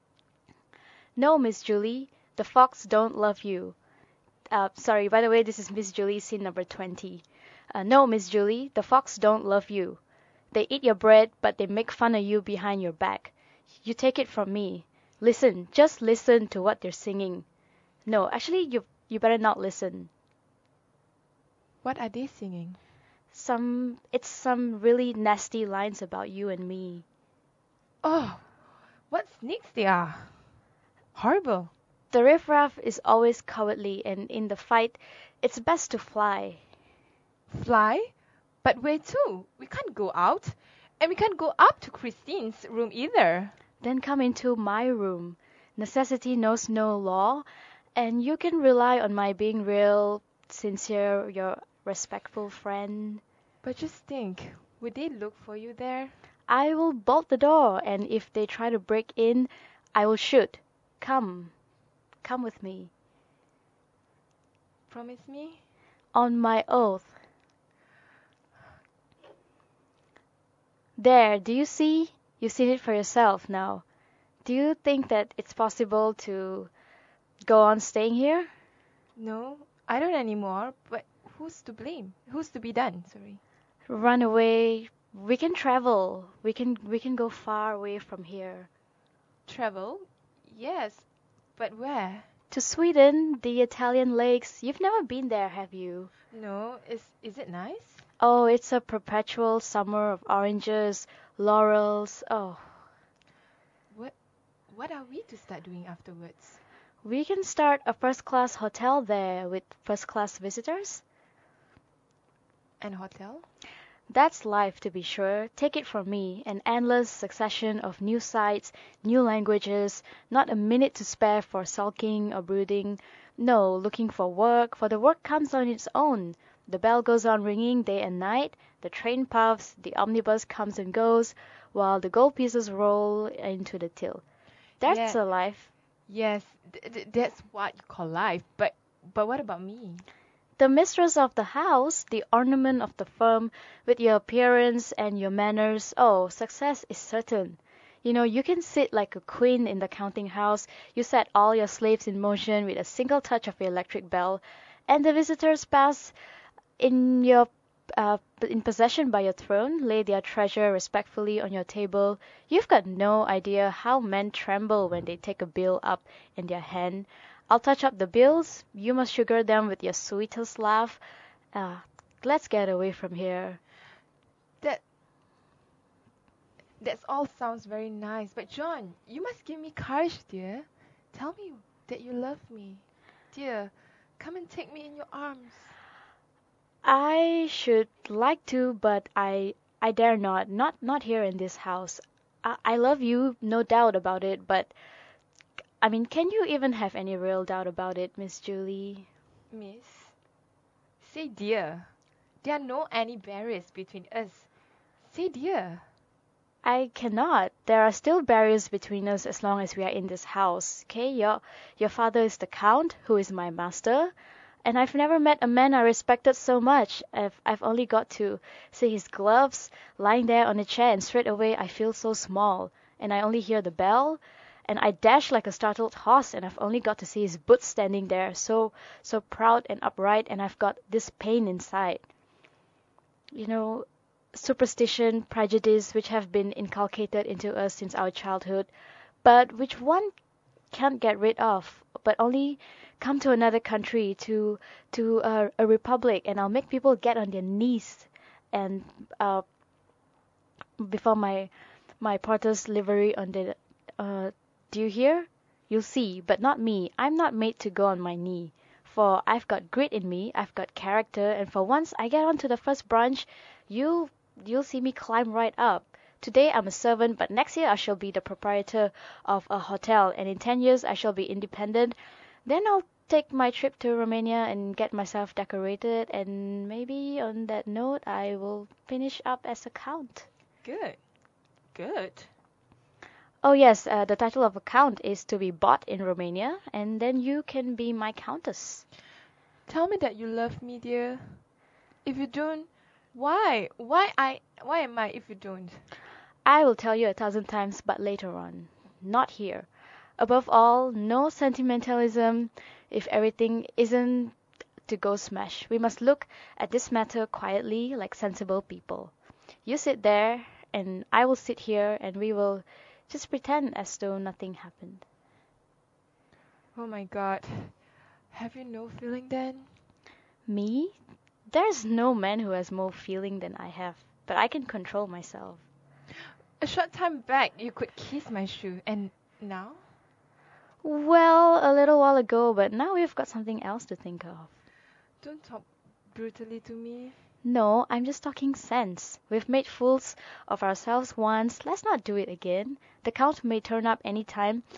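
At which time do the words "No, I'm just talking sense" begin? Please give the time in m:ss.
5:37.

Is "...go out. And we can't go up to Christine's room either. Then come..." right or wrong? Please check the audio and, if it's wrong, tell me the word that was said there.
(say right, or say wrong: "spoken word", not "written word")
right.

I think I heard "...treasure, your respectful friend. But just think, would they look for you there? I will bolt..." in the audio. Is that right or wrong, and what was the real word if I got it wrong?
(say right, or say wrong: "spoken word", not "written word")
wrong: "sincere", not "treasure".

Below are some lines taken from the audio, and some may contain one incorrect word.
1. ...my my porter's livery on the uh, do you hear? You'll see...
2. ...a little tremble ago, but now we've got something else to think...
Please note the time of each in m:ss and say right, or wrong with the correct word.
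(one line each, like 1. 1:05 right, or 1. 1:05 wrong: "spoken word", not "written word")
1. 4:11 right
2. 5:31 wrong: "while", not "tremble".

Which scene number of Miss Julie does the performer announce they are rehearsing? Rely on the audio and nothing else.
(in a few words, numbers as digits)
20.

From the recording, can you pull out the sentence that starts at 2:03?
No, looking for work, for the work comes on its own.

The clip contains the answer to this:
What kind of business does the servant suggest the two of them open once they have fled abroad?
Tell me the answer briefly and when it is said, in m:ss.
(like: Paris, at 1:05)
A first class hotel, at 1:47.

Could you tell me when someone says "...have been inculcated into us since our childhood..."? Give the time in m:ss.
3:56.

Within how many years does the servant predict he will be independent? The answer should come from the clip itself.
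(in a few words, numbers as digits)
10.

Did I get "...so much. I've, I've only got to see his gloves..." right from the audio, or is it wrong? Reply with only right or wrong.
right.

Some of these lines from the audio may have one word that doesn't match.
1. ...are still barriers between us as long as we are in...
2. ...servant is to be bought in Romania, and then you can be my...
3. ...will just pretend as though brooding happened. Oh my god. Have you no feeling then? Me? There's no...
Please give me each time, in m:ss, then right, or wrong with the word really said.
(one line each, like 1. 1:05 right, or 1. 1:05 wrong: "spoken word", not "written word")
1. 3:27 right
2. 4:44 wrong: "count", not "servant"
3. 5:12 wrong: "nothing", not "brooding".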